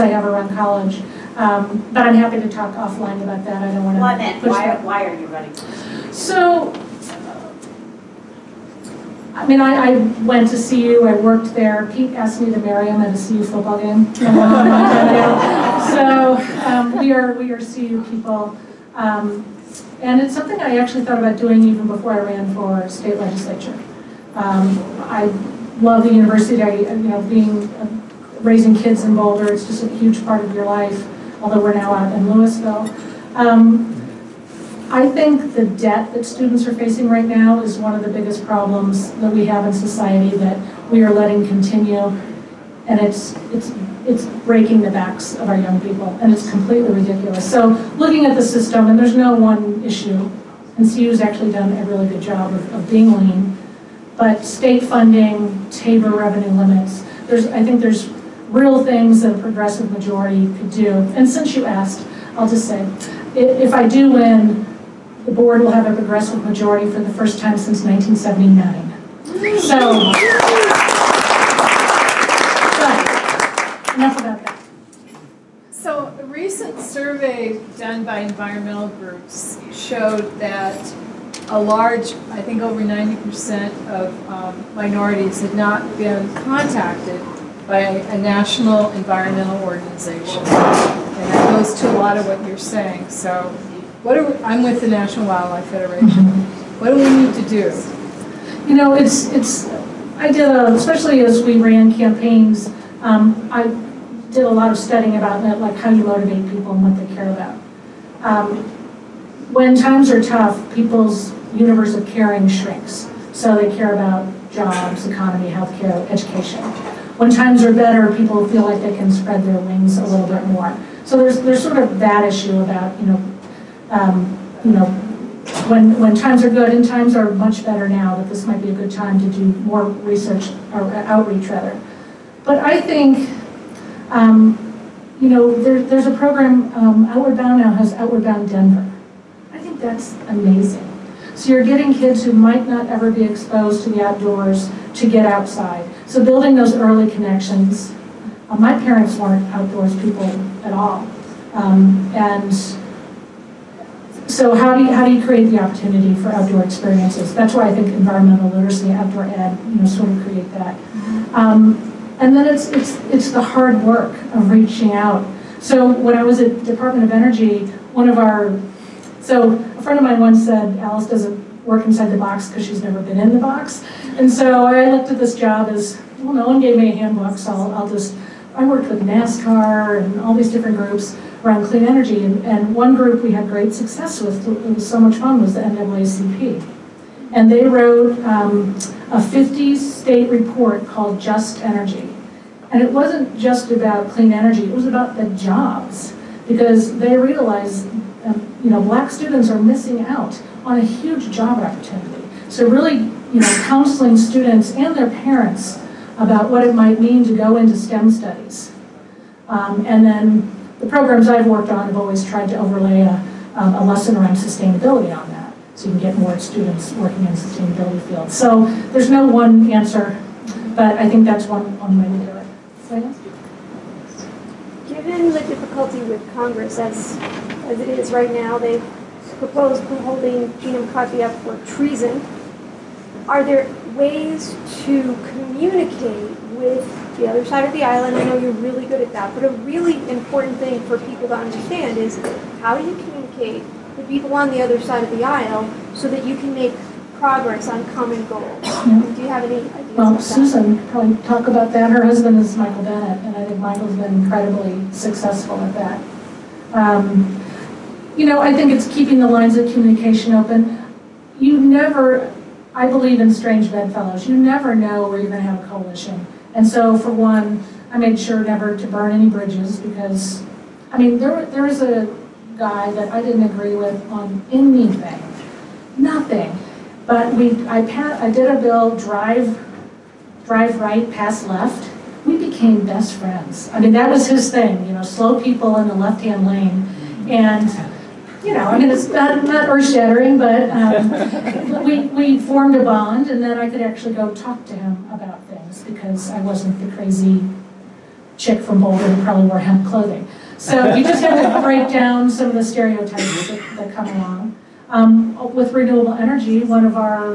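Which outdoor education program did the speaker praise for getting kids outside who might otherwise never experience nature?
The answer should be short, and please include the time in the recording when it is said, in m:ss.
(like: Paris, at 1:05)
Outward Bound Denver, at 2:17.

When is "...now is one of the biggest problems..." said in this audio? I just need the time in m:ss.
0:37.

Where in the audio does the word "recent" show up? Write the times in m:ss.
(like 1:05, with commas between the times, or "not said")
1:16.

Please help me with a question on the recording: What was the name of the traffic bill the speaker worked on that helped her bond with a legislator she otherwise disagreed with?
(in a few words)
Drive right, pass left.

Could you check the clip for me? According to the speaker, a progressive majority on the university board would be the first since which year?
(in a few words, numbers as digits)
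1979.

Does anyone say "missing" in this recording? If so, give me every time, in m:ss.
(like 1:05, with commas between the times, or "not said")
3:19.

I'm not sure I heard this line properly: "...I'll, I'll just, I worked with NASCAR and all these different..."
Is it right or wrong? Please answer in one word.
right.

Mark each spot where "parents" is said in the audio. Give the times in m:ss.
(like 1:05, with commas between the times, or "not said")
2:28, 3:25.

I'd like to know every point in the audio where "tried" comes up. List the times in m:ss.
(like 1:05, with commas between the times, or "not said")
3:32.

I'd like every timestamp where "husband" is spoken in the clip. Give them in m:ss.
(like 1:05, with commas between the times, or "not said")
4:12.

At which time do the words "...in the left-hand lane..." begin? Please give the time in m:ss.
4:45.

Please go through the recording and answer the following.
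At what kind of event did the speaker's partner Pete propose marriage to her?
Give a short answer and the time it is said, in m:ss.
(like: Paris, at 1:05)
CU football game, at 0:13.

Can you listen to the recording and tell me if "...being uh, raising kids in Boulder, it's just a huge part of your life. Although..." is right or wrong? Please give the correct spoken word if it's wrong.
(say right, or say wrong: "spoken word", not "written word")
right.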